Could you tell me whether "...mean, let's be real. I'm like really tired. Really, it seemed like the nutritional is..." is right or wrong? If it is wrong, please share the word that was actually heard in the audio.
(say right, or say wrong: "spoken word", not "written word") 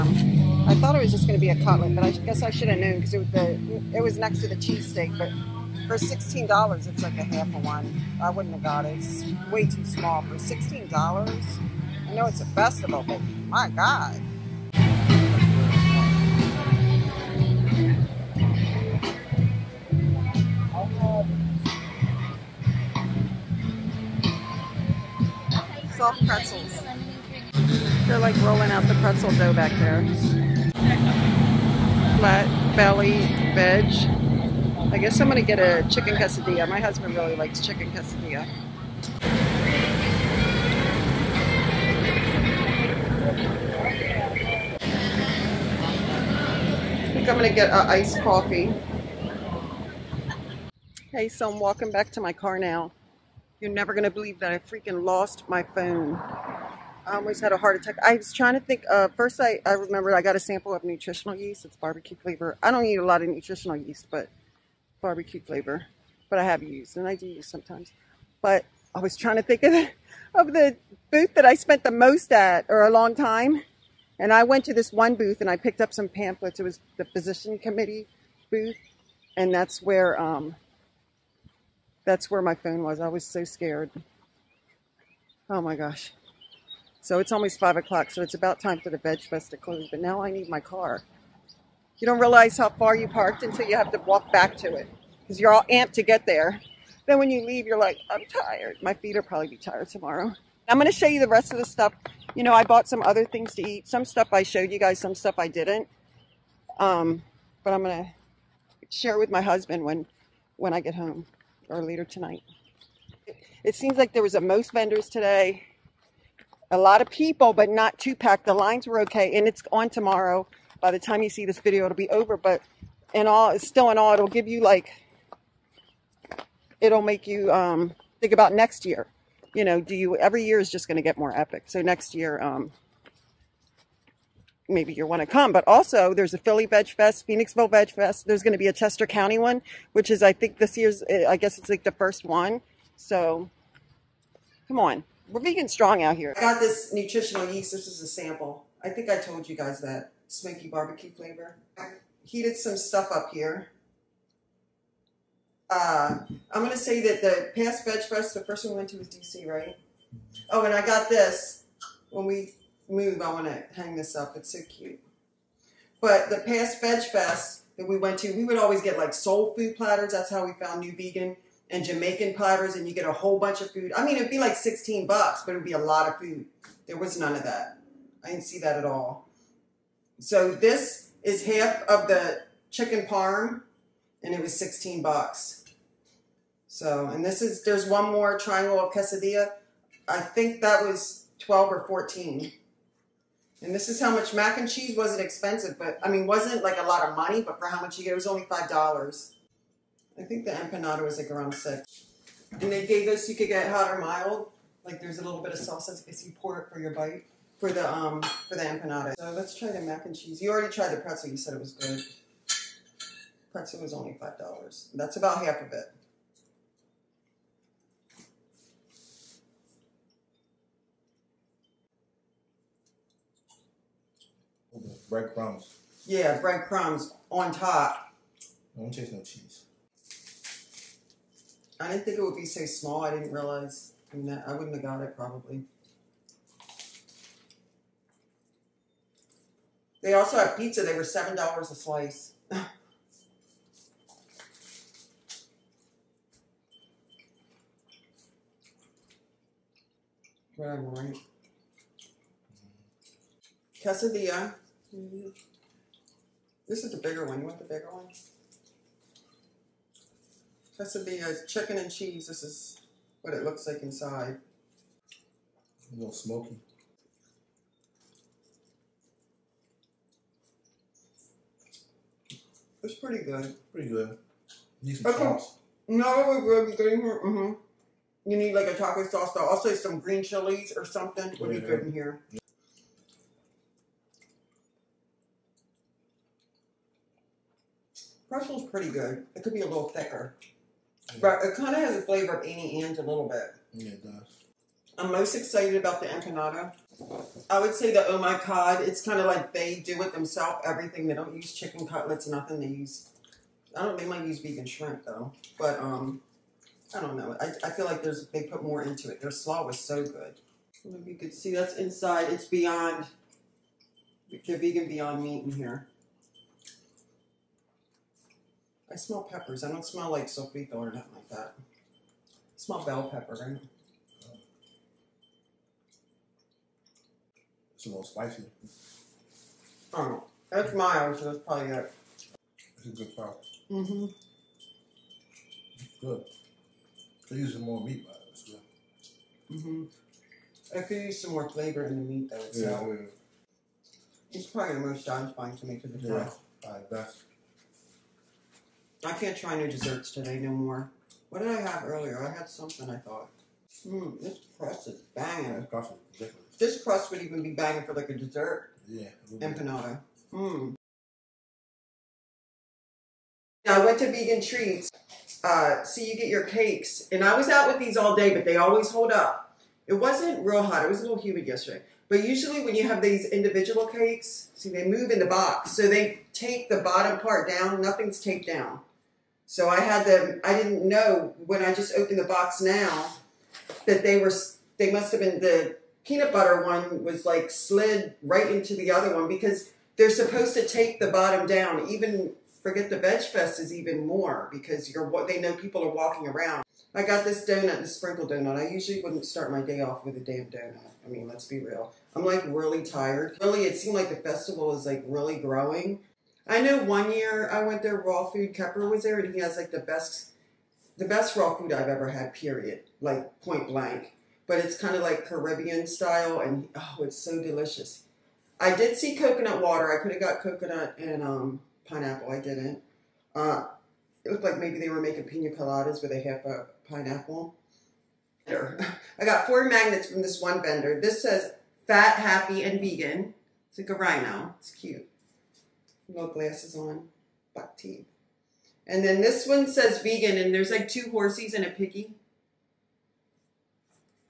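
wrong: "festival", not "nutritional".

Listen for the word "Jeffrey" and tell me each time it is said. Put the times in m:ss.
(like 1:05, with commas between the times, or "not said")
not said.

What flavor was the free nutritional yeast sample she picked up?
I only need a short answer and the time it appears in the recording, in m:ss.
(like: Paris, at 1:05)
Smoky barbecue, at 2:30.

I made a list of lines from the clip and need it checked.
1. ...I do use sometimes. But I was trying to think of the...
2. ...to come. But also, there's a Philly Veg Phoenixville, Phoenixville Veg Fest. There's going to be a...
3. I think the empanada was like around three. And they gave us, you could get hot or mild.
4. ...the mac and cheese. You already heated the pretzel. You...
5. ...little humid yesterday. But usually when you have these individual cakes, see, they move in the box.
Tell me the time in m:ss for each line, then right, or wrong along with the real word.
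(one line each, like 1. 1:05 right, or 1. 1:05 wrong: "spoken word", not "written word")
1. 1:07 right
2. 2:15 wrong: "Fest", not "Phoenixville"
3. 3:20 wrong: "six", not "three"
4. 3:29 wrong: "tried", not "heated"
5. 6:11 right.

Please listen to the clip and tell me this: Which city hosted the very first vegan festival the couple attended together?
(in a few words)
D.C.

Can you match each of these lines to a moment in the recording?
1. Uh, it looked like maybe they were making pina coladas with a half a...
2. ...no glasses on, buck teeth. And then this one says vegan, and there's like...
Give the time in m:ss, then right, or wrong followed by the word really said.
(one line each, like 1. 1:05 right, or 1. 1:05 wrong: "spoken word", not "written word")
1. 7:03 right
2. 7:16 right.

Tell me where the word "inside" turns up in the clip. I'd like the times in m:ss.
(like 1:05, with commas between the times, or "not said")
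4:23, 5:11.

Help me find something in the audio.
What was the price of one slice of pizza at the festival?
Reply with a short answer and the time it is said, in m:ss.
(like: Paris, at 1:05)
$7, at 4:01.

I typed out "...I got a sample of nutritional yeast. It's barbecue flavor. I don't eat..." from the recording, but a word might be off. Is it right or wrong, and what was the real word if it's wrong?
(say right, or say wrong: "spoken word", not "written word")
right.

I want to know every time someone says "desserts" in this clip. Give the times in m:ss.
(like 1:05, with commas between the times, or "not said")
5:49, 5:58.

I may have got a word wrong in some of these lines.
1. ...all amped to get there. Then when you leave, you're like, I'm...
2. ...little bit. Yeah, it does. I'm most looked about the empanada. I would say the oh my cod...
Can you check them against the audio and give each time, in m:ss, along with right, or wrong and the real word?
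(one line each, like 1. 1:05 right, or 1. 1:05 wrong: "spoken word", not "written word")
1. 1:35 right
2. 4:53 wrong: "excited", not "looked".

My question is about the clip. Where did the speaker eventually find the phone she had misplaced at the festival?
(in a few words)
Physician committee booth.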